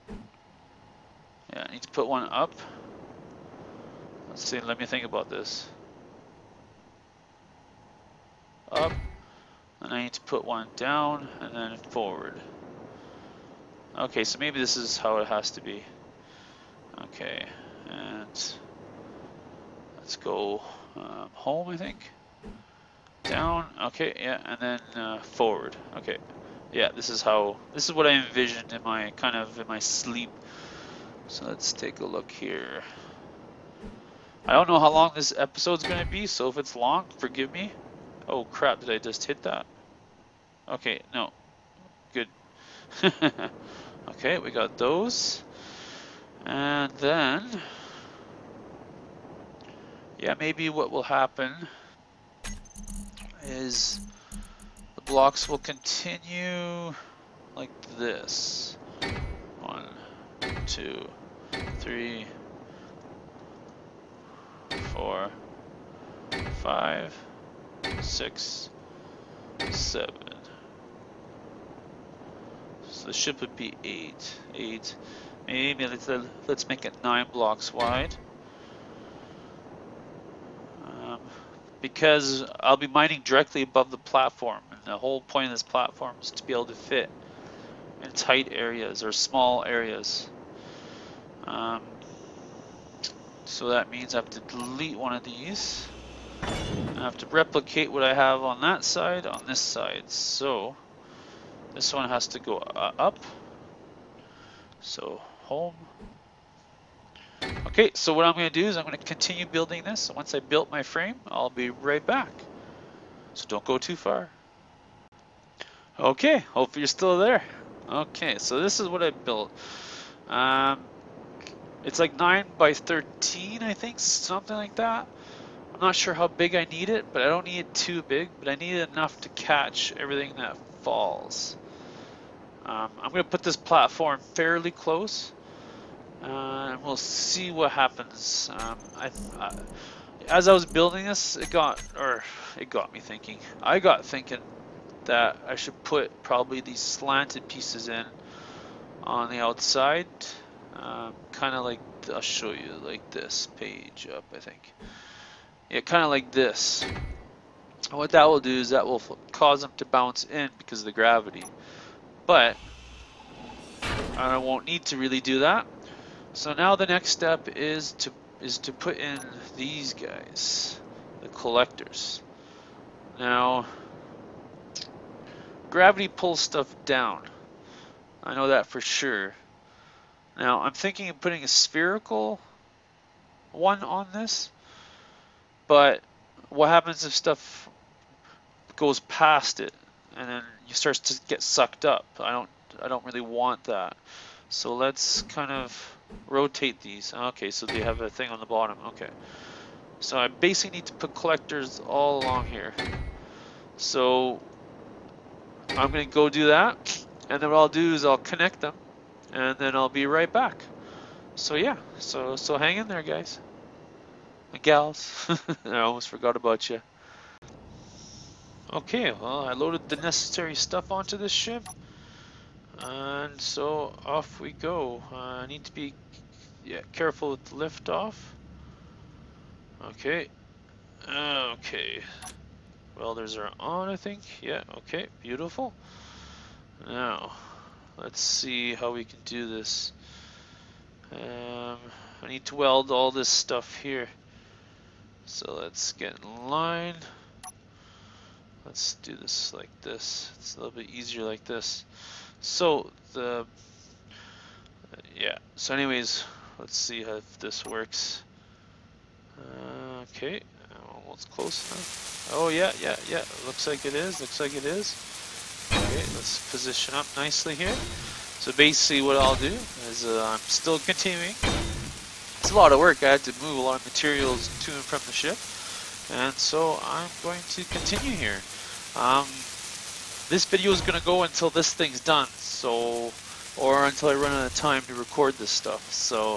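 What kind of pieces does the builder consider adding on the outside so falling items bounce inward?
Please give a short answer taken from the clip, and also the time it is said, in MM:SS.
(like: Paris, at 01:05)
slanted pieces, at 02:26.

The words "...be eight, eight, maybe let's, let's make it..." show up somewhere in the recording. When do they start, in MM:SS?
01:13.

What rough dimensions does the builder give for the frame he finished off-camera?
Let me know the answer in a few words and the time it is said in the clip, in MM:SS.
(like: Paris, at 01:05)
9 by 13, at 02:02.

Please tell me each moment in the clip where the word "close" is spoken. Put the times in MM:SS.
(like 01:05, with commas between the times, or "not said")
02:14, 04:21.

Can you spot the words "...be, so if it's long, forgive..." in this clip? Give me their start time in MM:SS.
00:36.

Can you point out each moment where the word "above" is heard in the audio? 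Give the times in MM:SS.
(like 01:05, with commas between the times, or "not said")
01:23.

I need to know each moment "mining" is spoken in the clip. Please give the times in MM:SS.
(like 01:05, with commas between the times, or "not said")
01:22.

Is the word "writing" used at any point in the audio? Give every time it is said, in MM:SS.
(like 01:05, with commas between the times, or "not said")
not said.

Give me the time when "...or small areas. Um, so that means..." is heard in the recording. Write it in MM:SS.
01:29.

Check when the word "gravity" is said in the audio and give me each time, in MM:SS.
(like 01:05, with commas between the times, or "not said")
02:40, 02:55.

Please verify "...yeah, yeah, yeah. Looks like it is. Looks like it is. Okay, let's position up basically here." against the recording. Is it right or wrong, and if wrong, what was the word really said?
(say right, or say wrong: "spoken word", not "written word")
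wrong: "nicely", not "basically".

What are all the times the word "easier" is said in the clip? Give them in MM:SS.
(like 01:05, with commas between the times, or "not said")
04:10.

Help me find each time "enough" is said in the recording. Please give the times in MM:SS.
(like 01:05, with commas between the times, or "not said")
02:08, 04:21.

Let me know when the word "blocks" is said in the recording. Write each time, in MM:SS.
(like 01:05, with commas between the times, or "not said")
00:55, 01:17.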